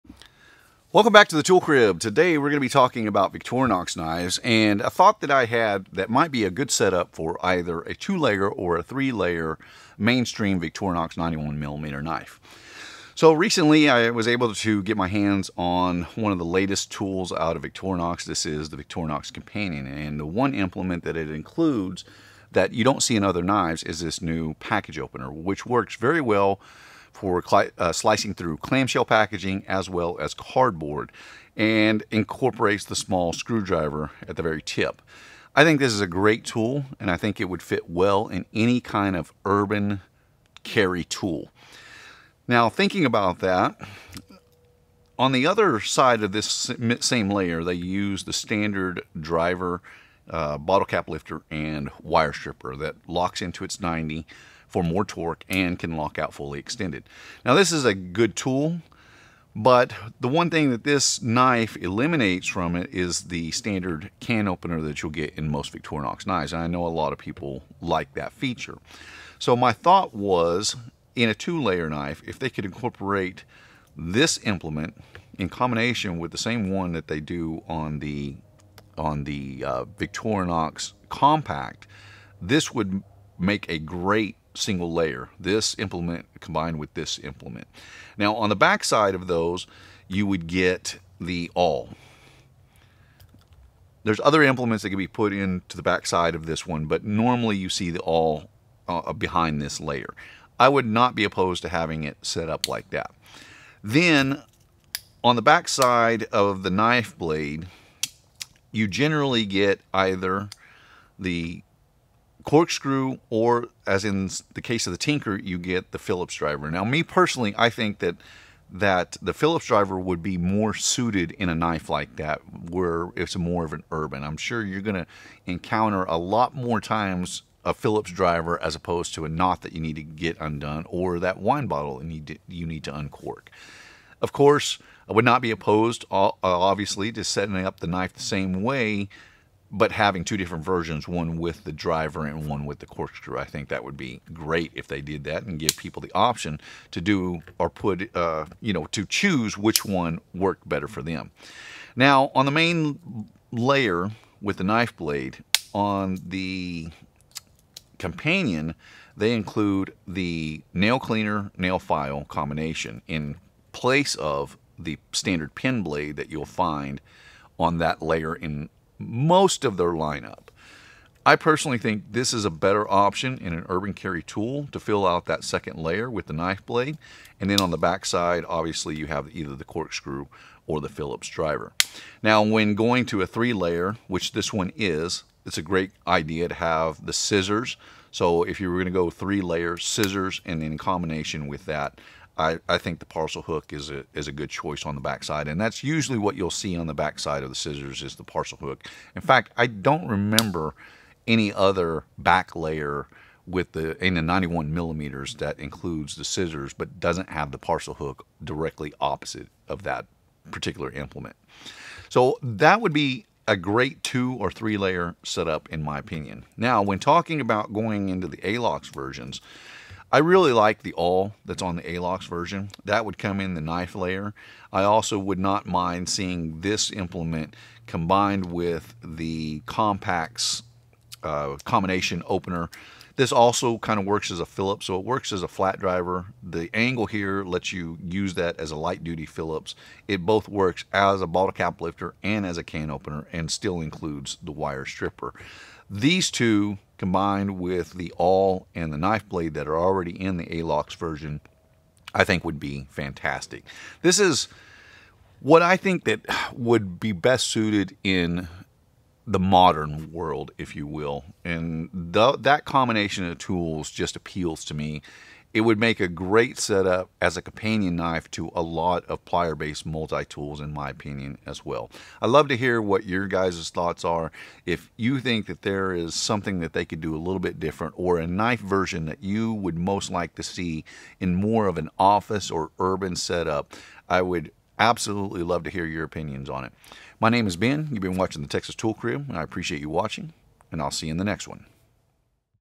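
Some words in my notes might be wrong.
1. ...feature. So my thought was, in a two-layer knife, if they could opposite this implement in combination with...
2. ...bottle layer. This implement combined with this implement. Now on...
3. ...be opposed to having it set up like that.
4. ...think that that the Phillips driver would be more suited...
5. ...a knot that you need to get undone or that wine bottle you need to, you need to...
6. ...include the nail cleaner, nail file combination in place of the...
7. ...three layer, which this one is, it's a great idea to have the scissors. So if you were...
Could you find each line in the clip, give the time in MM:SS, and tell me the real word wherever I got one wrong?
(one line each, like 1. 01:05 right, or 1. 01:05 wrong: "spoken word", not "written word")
1. 01:08 wrong: "incorporate", not "opposite"
2. 01:24 wrong: "single", not "bottle"
3. 01:41 right
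4. 01:57 right
5. 02:09 right
6. 02:39 right
7. 03:03 right.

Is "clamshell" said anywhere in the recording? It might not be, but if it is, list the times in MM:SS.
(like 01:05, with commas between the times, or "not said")
00:28.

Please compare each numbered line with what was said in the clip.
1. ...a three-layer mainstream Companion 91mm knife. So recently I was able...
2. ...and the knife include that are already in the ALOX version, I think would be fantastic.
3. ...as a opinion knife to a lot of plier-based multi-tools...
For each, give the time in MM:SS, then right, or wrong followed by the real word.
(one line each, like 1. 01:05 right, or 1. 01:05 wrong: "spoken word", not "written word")
1. 00:08 wrong: "Victorinox", not "Companion"
2. 04:08 wrong: "blade", not "include"
3. 04:27 wrong: "companion", not "opinion".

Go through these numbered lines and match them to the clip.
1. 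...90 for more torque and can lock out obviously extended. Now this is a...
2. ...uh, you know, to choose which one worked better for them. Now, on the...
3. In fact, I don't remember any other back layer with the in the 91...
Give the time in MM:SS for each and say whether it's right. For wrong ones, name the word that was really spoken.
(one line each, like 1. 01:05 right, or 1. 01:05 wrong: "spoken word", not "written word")
1. 00:53 wrong: "fully", not "obviously"
2. 02:28 right
3. 03:19 right.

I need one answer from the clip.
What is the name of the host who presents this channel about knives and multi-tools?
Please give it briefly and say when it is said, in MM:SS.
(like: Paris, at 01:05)
Ben, at 04:47.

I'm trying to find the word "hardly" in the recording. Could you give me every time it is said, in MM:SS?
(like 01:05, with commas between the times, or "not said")
not said.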